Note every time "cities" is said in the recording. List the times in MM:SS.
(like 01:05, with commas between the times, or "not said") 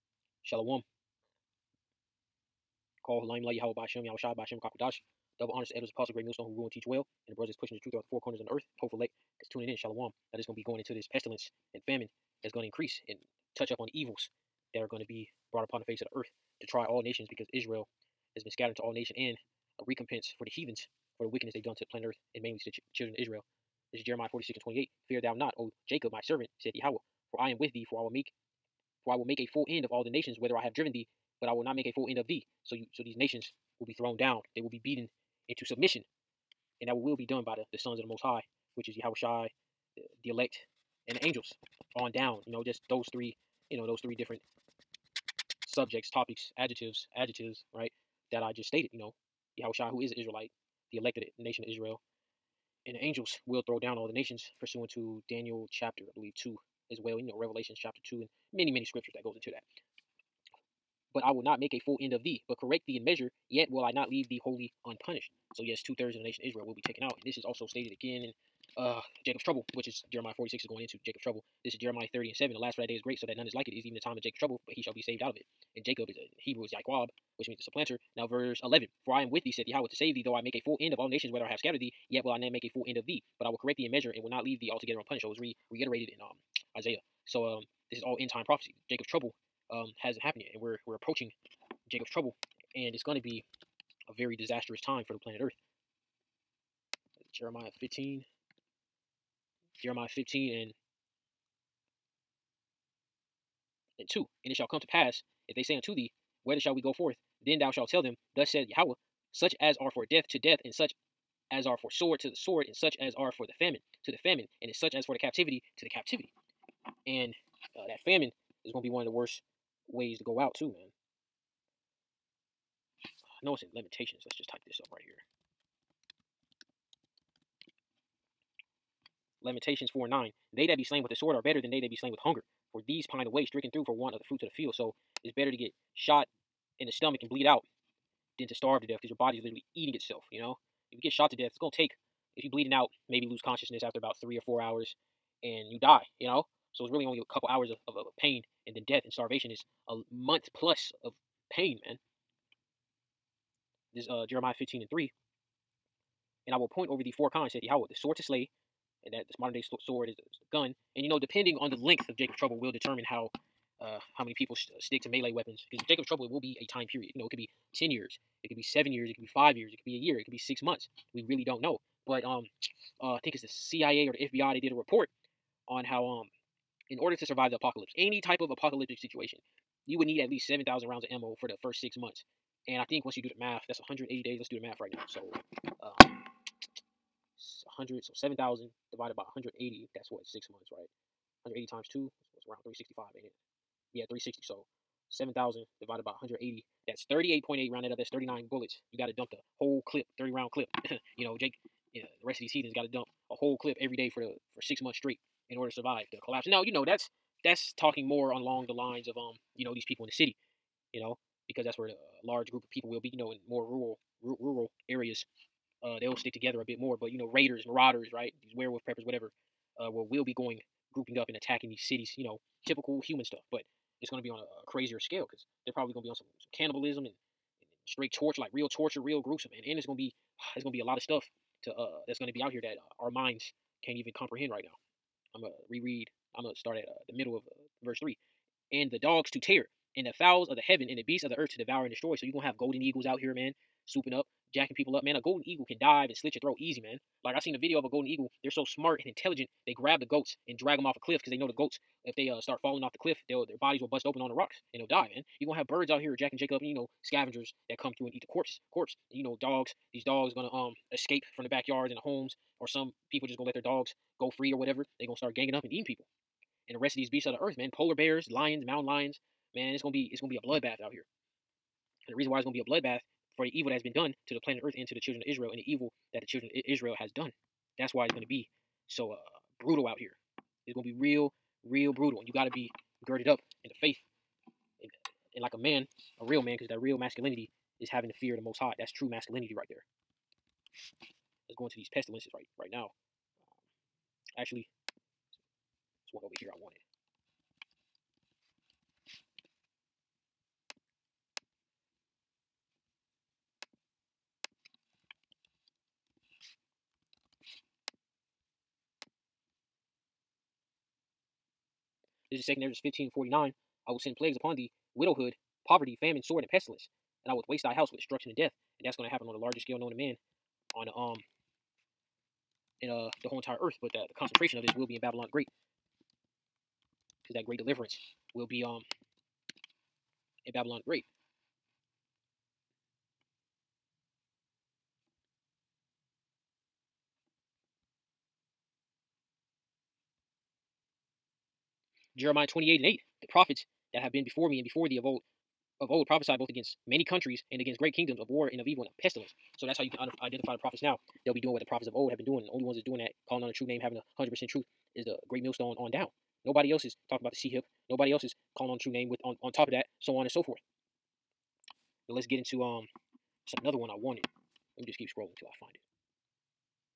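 03:41.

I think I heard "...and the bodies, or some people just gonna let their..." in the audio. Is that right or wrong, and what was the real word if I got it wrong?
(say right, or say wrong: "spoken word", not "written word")
wrong: "homes", not "bodies".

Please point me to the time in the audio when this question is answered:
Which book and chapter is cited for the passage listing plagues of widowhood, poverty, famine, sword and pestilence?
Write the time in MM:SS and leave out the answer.
05:12.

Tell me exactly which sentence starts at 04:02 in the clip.
So you're gonna have golden eagles out here, man, swooping up, jacking people up, man.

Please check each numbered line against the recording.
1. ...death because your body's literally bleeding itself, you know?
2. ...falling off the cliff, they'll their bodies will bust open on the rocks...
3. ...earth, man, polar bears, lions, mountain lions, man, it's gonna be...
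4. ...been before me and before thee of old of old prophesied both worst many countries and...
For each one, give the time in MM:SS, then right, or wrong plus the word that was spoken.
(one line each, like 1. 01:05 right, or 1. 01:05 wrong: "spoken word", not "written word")
1. 02:18 wrong: "eating", not "bleeding"
2. 04:12 right
3. 04:27 right
4. 05:44 wrong: "against", not "worst".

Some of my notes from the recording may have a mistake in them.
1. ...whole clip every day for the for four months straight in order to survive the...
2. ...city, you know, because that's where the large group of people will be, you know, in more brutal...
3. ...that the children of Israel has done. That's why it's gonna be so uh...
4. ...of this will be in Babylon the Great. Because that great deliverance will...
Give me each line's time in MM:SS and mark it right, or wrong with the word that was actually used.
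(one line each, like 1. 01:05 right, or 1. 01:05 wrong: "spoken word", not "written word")
1. 03:23 wrong: "six", not "four"
2. 03:30 wrong: "rural", not "brutal"
3. 04:36 right
4. 05:24 right.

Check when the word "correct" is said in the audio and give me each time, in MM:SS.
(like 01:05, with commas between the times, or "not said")
01:02, 01:23.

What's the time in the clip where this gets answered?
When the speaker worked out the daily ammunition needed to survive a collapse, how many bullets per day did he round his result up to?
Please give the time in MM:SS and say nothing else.
03:18.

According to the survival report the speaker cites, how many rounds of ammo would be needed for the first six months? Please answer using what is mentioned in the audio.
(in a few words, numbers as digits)
7,000.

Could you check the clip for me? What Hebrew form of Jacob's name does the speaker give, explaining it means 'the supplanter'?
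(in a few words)
Yaquab.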